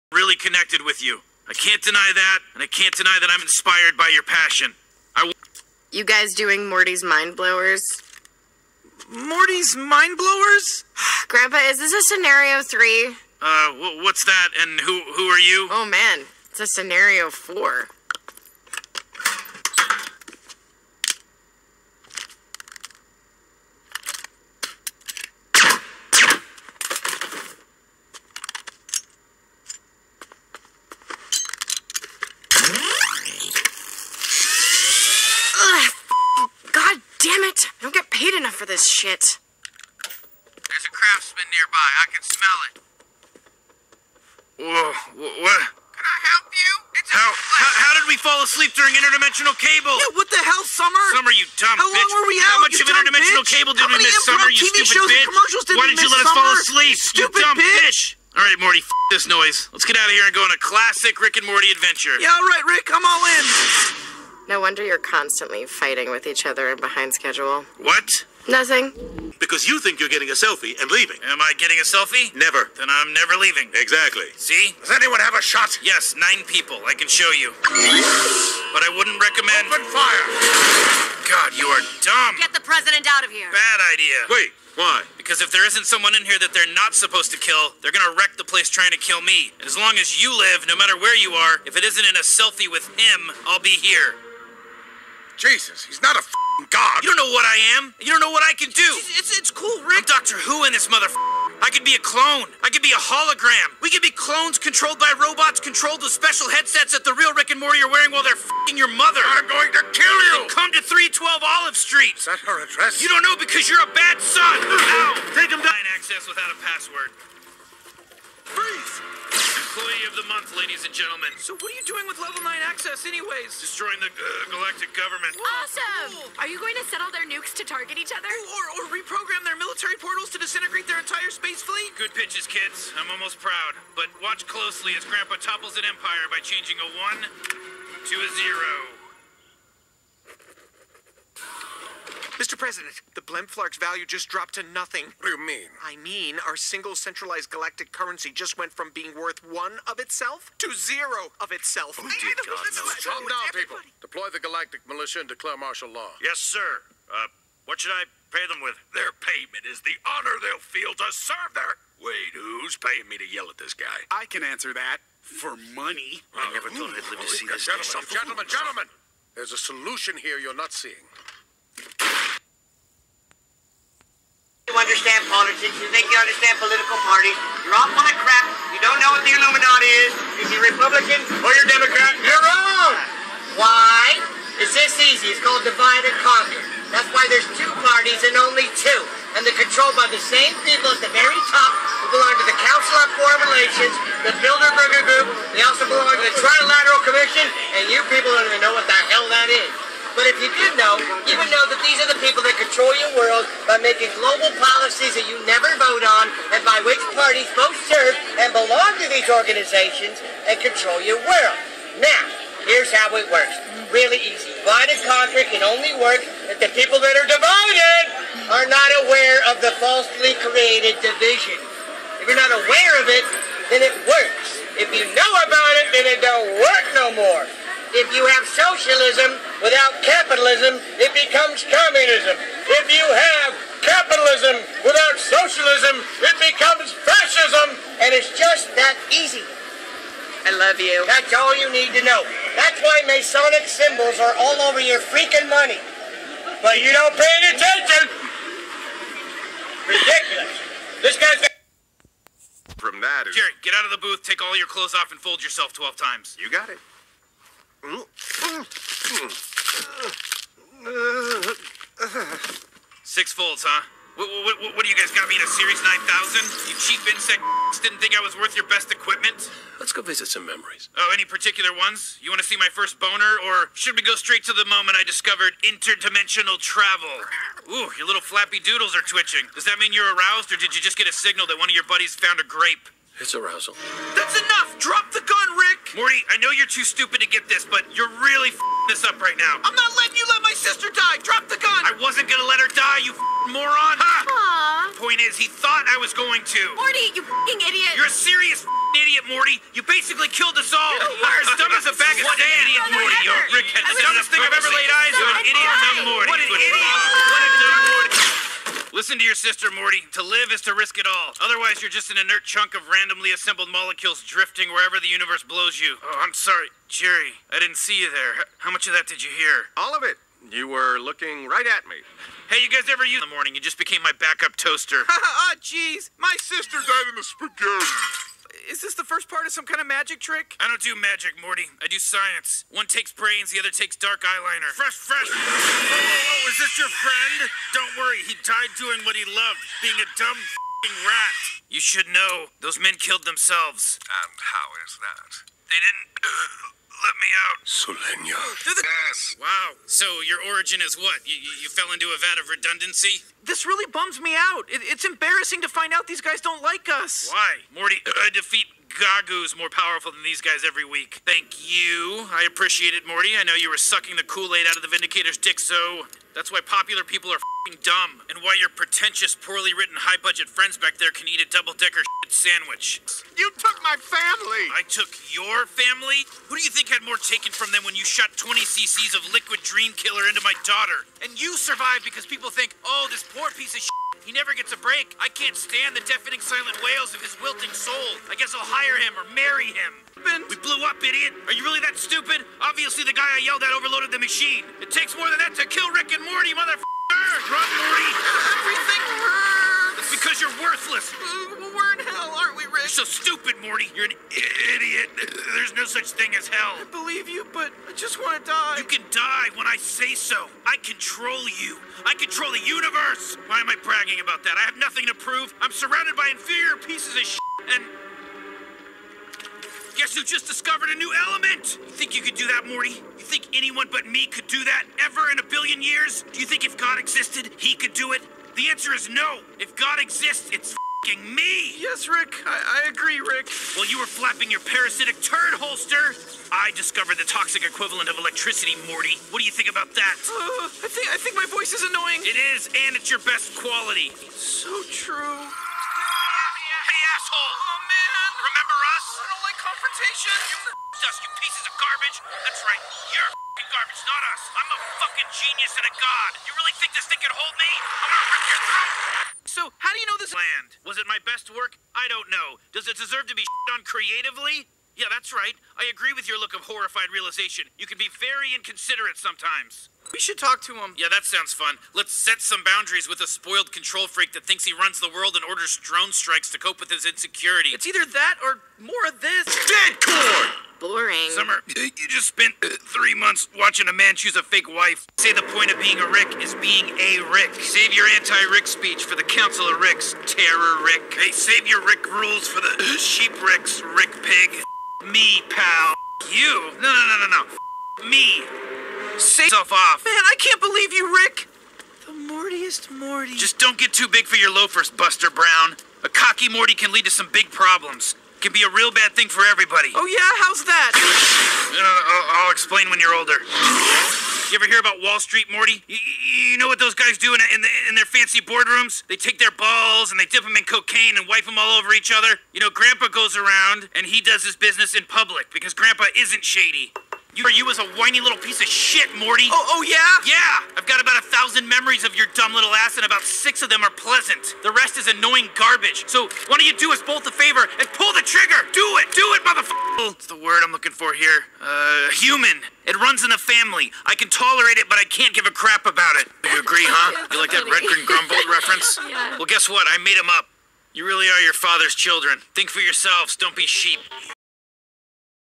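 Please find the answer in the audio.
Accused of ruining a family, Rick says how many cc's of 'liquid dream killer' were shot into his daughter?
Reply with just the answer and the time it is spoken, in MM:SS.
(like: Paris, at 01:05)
20, at 06:18.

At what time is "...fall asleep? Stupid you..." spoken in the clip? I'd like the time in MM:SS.
00:56.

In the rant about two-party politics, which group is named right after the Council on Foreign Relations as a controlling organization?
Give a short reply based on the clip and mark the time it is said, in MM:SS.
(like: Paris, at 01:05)
Bilderberger Group, at 03:14.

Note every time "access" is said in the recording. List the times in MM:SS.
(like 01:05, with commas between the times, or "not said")
01:55, 02:02.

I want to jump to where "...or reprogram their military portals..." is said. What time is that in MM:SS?
02:08.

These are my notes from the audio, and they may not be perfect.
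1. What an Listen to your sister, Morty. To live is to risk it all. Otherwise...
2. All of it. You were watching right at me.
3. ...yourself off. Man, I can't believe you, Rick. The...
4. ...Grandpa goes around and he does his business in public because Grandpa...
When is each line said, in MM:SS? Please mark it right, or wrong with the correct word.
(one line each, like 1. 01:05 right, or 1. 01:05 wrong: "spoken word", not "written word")
1. 05:06 right
2. 05:19 wrong: "looking", not "watching"
3. 08:19 right
4. 08:42 right.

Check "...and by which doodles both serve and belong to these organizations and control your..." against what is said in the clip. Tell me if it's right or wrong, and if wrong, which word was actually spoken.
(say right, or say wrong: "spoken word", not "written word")
wrong: "parties", not "doodles".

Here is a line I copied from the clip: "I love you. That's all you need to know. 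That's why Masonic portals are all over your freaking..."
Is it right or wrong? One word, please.
wrong.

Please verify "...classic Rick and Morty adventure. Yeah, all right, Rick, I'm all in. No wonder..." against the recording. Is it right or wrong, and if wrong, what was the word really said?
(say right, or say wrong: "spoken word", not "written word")
right.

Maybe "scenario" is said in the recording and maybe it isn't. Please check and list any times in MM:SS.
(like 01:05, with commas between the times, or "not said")
00:12, 00:16.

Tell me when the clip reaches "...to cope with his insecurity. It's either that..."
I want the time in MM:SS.
07:56.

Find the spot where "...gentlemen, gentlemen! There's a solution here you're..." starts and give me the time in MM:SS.
02:48.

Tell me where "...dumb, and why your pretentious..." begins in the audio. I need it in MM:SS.
06:07.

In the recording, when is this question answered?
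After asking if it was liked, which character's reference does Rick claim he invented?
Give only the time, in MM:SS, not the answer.
09:07.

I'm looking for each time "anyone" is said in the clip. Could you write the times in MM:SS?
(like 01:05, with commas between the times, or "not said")
01:14, 07:03.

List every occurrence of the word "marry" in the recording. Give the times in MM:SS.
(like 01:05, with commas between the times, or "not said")
06:29.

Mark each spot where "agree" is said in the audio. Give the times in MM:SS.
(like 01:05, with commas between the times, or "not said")
07:12, 07:45, 09:06.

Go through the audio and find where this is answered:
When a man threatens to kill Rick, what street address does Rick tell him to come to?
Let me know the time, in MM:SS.
01:50.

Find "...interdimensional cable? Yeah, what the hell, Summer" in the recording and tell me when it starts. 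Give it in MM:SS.
00:48.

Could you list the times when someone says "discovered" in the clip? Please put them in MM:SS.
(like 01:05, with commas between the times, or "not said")
04:35, 07:00, 07:16.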